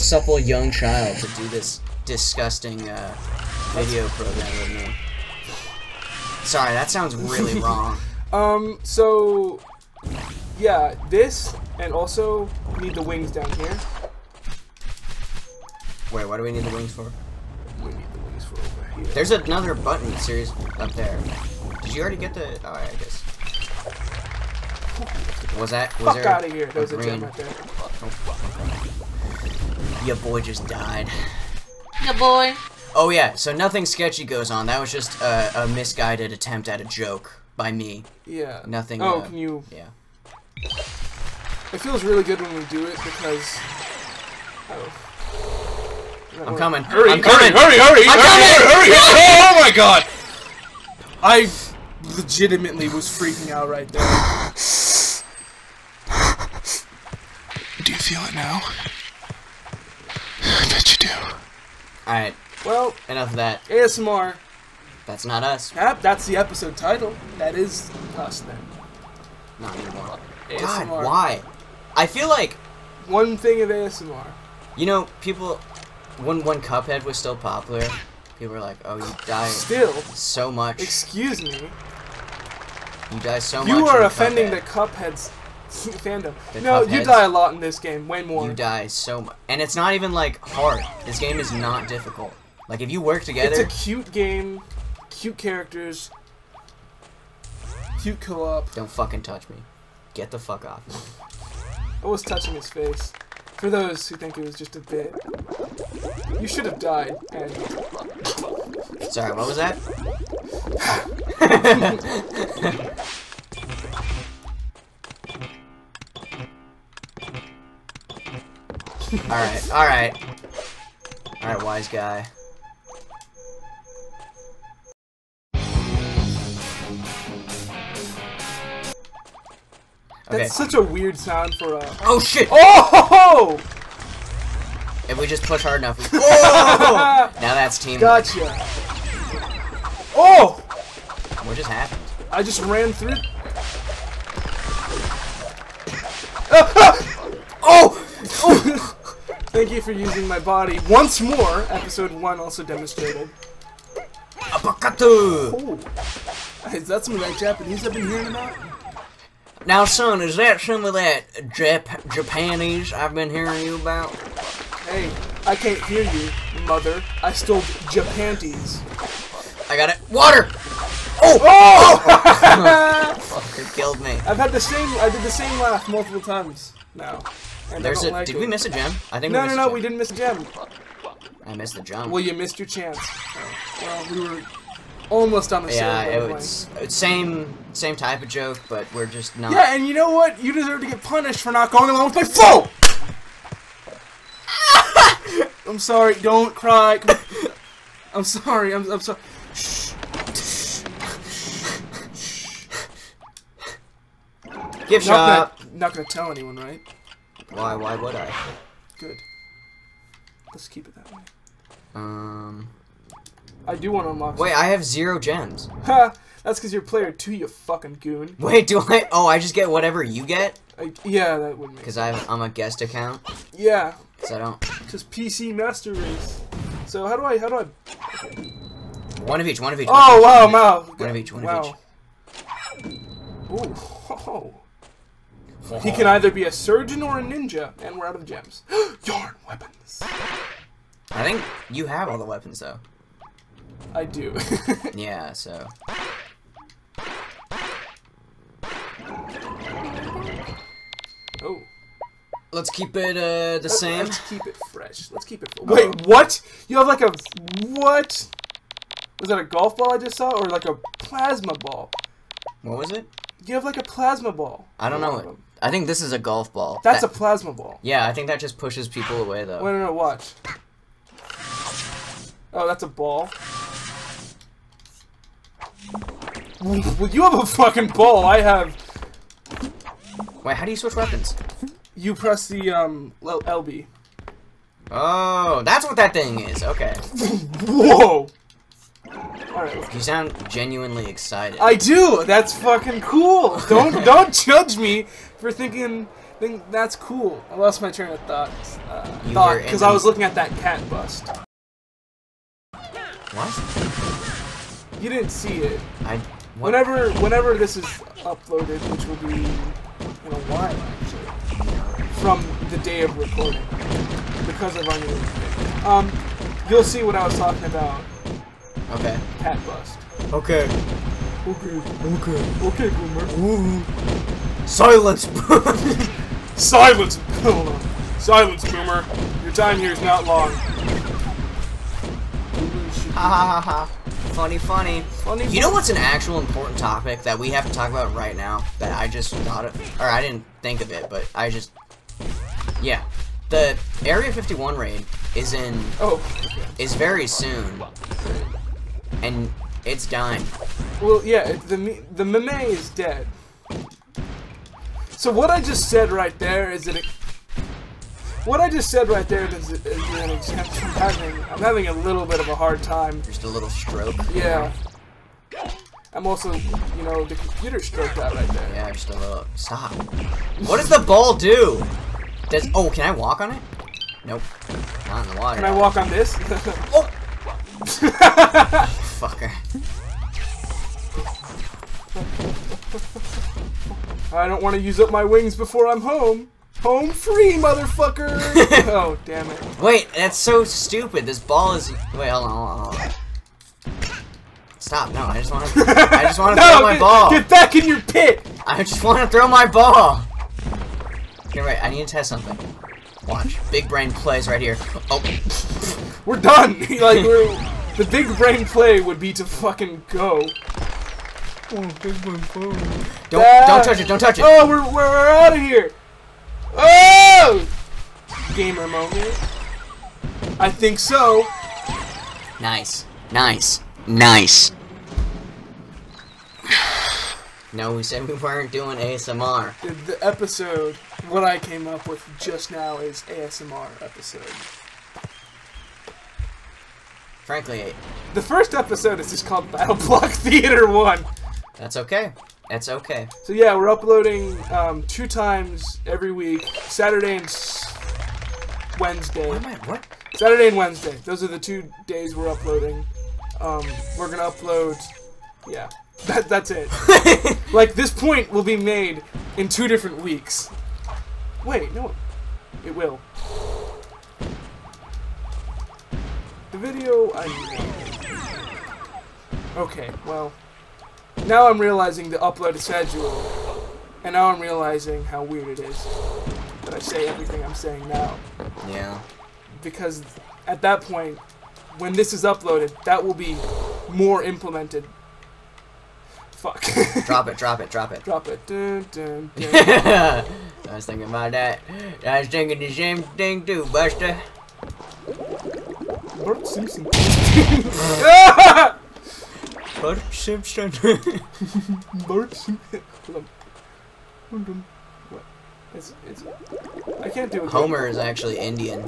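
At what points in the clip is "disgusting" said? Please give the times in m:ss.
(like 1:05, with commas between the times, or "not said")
0:02.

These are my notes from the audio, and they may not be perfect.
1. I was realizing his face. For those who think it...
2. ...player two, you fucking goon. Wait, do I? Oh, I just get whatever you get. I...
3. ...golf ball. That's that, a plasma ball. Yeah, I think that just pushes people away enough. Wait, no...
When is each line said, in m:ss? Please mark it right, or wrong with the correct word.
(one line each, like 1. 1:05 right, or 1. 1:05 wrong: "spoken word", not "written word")
1. 1:42 wrong: "touching", not "realizing"
2. 3:36 right
3. 4:26 wrong: "though", not "enough".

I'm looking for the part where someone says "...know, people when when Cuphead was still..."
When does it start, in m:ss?
1:14.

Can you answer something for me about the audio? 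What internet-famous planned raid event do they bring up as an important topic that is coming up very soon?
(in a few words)
Area 51 raid.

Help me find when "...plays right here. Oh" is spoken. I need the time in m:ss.
6:44.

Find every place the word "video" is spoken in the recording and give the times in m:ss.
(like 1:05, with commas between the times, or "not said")
0:03, 7:46.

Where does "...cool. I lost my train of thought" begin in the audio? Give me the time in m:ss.
4:56.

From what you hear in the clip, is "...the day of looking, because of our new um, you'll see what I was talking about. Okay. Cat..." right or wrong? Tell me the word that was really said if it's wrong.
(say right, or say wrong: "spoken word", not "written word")
wrong: "recording", not "looking".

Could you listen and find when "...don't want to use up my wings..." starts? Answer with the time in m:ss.
6:24.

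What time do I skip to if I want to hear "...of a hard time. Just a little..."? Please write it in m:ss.
6:02.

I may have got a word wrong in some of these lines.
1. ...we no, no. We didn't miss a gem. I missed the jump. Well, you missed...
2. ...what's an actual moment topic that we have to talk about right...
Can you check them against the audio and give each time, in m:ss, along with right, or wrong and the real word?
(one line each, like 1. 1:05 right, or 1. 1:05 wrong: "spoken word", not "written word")
1. 2:59 right
2. 5:35 wrong: "important", not "moment".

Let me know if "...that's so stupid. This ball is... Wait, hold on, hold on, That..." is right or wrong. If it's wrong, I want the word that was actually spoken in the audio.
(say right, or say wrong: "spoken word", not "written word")
wrong: "Stop", not "That".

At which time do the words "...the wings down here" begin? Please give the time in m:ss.
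0:12.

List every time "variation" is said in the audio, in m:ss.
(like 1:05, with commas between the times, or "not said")
not said.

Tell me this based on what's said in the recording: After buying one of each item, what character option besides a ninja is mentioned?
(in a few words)
surgeon.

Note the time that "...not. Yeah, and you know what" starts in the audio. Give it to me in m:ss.
3:09.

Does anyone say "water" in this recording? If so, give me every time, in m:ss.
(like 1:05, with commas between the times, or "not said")
2:50, 6:15.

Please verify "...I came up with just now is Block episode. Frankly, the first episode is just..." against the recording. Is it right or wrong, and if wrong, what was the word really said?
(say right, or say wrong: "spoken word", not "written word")
wrong: "ASMR", not "Block".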